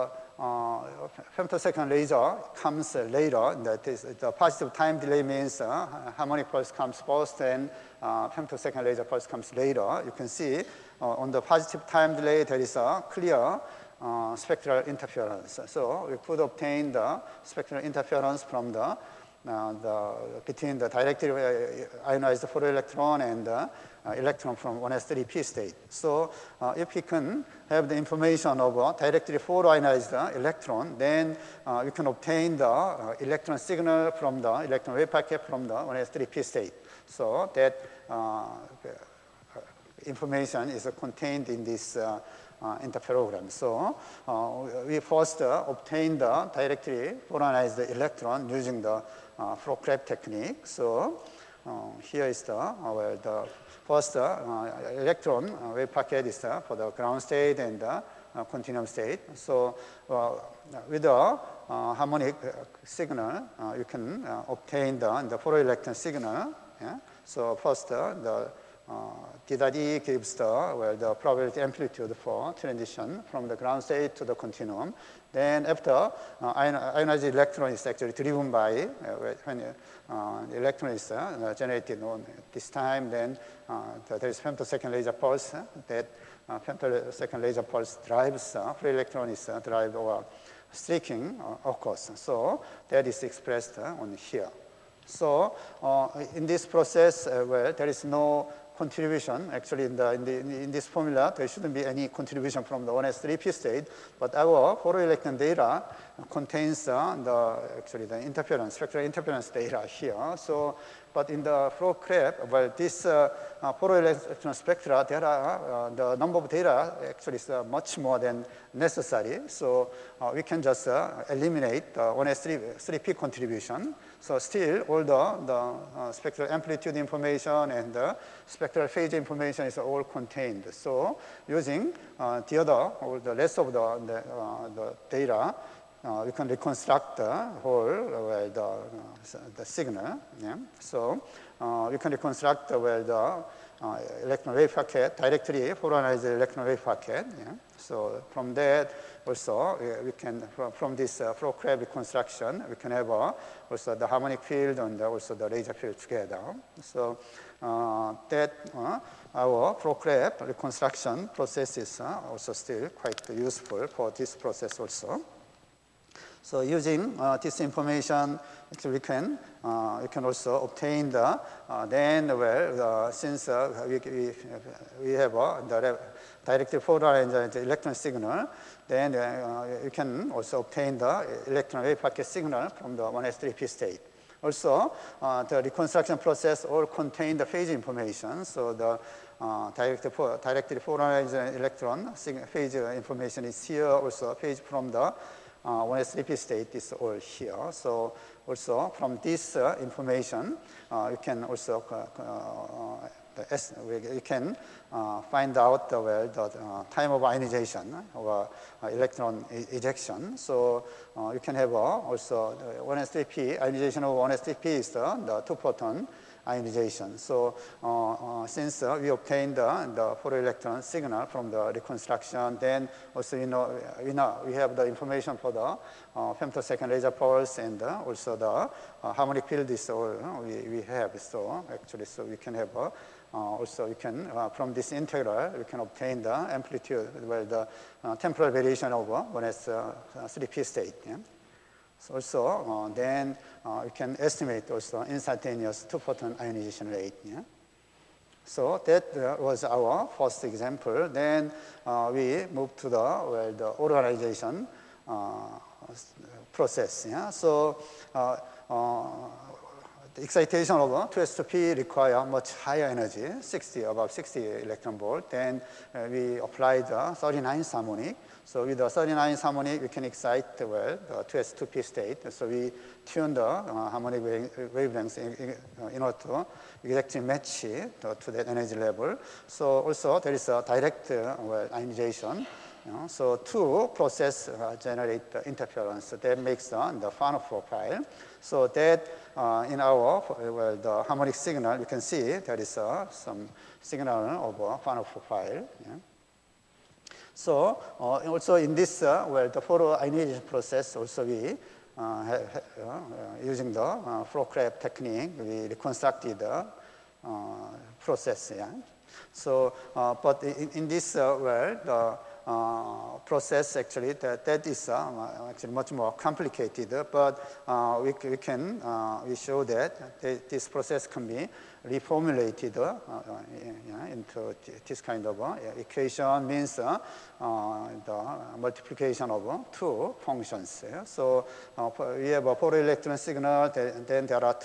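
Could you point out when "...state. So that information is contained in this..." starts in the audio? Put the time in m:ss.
0:36.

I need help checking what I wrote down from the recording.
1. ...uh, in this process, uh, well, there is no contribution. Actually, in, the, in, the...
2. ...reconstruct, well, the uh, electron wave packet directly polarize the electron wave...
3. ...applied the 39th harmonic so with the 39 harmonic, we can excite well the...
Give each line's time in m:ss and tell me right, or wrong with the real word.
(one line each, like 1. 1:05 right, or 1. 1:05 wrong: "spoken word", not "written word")
1. 1:35 right
2. 2:22 right
3. 4:26 right.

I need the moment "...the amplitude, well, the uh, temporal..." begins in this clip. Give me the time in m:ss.
3:56.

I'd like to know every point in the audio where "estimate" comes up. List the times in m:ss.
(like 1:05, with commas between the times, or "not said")
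4:04.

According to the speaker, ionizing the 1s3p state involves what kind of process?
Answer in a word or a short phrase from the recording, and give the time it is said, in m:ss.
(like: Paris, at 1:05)
two photon ionization, at 3:35.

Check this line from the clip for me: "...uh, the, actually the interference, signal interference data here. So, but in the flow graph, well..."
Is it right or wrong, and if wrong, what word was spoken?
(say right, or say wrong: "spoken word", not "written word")
wrong: "spectral", not "signal".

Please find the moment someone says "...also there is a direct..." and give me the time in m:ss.
4:39.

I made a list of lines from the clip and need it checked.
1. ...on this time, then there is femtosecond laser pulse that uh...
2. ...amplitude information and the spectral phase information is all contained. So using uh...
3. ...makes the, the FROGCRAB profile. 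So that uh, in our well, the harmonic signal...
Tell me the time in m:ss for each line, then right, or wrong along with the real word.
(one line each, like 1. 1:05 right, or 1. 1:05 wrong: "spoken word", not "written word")
1. 1:22 right
2. 2:06 right
3. 4:46 wrong: "Fano", not "FROGCRAB".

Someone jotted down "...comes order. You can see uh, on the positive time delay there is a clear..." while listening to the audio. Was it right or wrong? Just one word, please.
wrong.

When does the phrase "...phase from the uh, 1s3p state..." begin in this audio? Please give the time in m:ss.
3:14.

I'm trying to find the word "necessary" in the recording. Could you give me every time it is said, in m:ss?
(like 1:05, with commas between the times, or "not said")
1:58.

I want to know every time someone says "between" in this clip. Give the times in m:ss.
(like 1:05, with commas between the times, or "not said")
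0:20.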